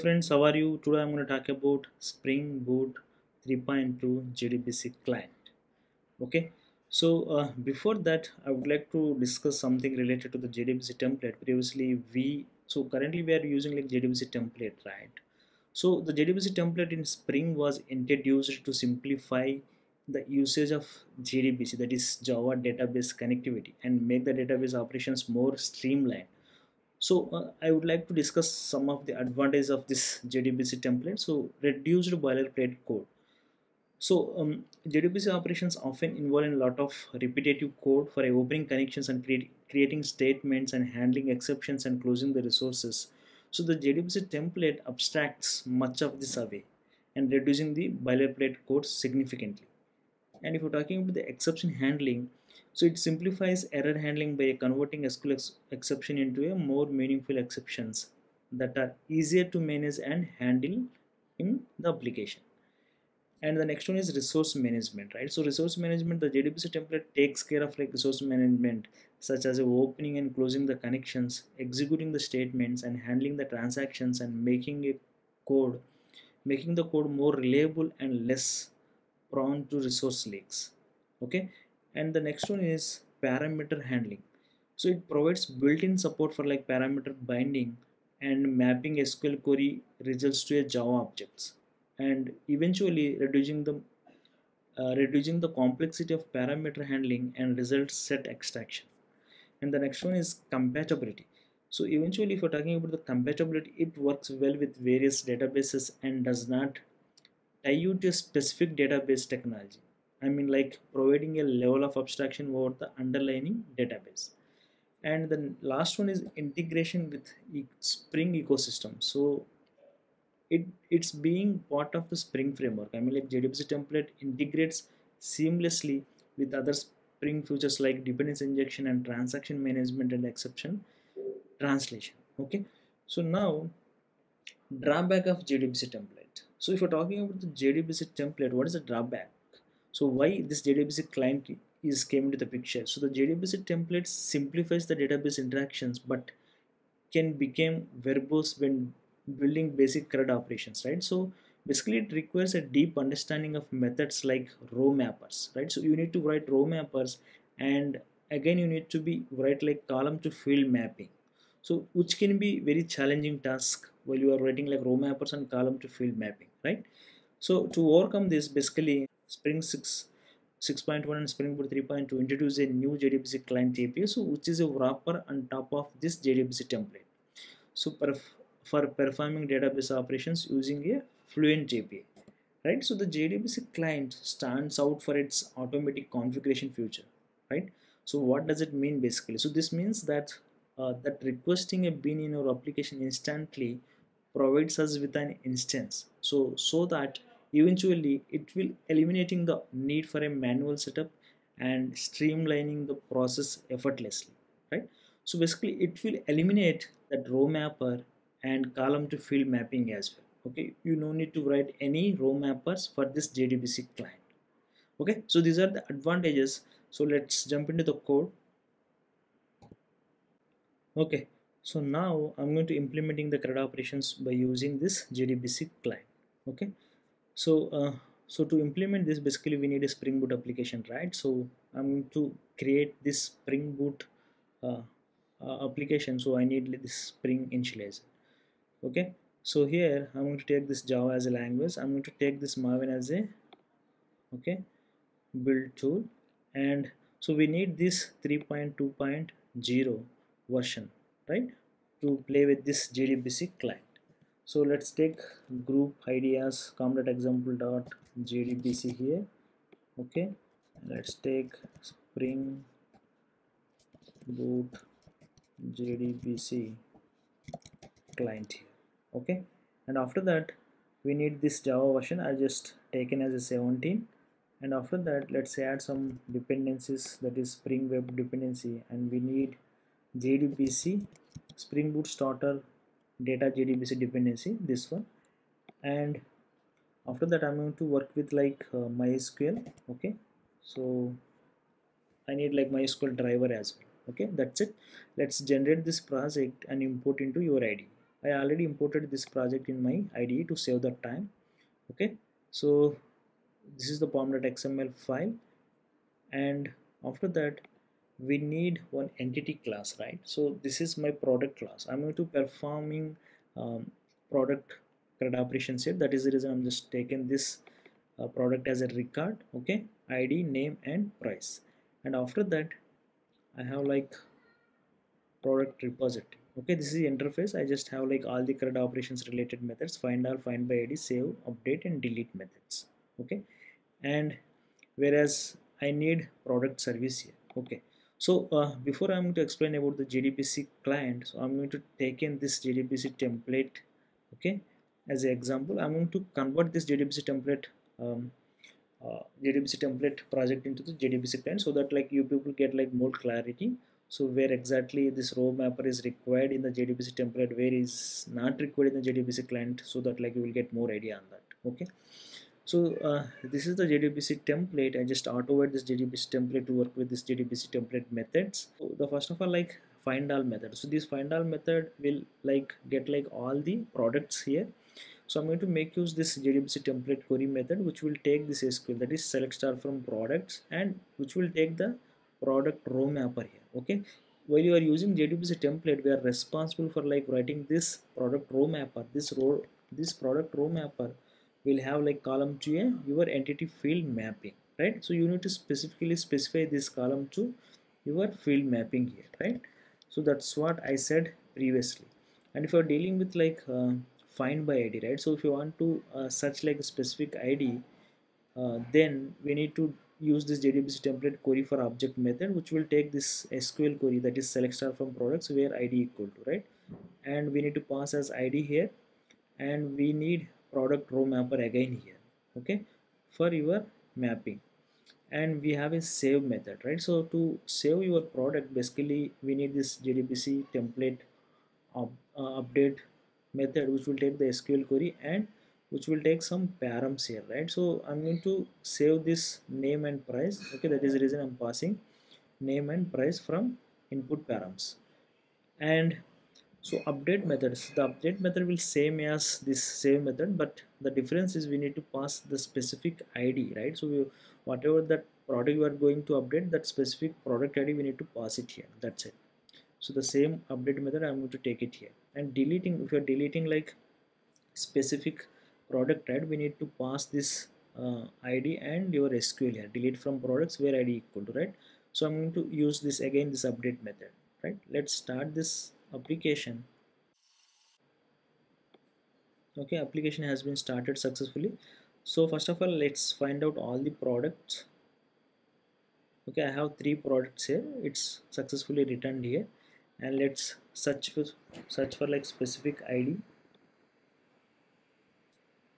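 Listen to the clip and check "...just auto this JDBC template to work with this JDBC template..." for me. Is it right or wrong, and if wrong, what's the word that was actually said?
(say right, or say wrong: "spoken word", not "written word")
right.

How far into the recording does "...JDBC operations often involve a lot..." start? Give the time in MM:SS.
00:34.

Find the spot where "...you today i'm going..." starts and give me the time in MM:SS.
00:00.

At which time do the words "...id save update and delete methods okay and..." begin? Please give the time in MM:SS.
05:30.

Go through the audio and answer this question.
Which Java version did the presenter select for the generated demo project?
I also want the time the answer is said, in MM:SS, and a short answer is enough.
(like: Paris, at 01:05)
17, at 04:33.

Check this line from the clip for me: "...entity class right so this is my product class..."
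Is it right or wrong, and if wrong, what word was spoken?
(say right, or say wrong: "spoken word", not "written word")
right.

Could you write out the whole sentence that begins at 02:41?
So which can be very challenging task while you are writing like row mappers and column to field mapping, right?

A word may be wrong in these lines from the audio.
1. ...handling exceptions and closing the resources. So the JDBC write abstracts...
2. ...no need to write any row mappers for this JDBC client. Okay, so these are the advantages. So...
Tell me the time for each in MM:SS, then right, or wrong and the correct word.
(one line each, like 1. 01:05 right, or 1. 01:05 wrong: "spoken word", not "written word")
1. 00:40 wrong: "template", not "write"
2. 03:30 right.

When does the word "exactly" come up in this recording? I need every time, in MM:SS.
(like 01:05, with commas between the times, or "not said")
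05:54.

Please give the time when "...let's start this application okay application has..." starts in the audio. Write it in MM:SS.
07:54.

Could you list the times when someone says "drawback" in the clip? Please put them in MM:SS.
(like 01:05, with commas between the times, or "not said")
02:14, 02:18.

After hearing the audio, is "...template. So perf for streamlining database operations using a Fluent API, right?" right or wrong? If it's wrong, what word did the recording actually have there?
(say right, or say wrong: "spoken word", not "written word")
wrong: "performing", not "streamlining".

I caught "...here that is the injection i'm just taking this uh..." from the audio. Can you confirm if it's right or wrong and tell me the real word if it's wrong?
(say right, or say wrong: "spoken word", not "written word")
wrong: "reason", not "injection".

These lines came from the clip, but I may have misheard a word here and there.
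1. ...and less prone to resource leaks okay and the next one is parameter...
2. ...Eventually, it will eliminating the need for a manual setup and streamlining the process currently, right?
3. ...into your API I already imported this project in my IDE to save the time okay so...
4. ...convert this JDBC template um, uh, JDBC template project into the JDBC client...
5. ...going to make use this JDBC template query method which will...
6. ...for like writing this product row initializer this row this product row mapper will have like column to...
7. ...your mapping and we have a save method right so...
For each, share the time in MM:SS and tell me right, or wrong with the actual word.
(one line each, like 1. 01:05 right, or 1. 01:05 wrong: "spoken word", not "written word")
1. 01:17 right
2. 03:17 wrong: "effortlessly", not "currently"
3. 04:57 wrong: "IDE", not "API"
4. 05:46 right
5. 06:15 right
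6. 06:26 wrong: "mapper", not "initializer"
7. 07:03 right.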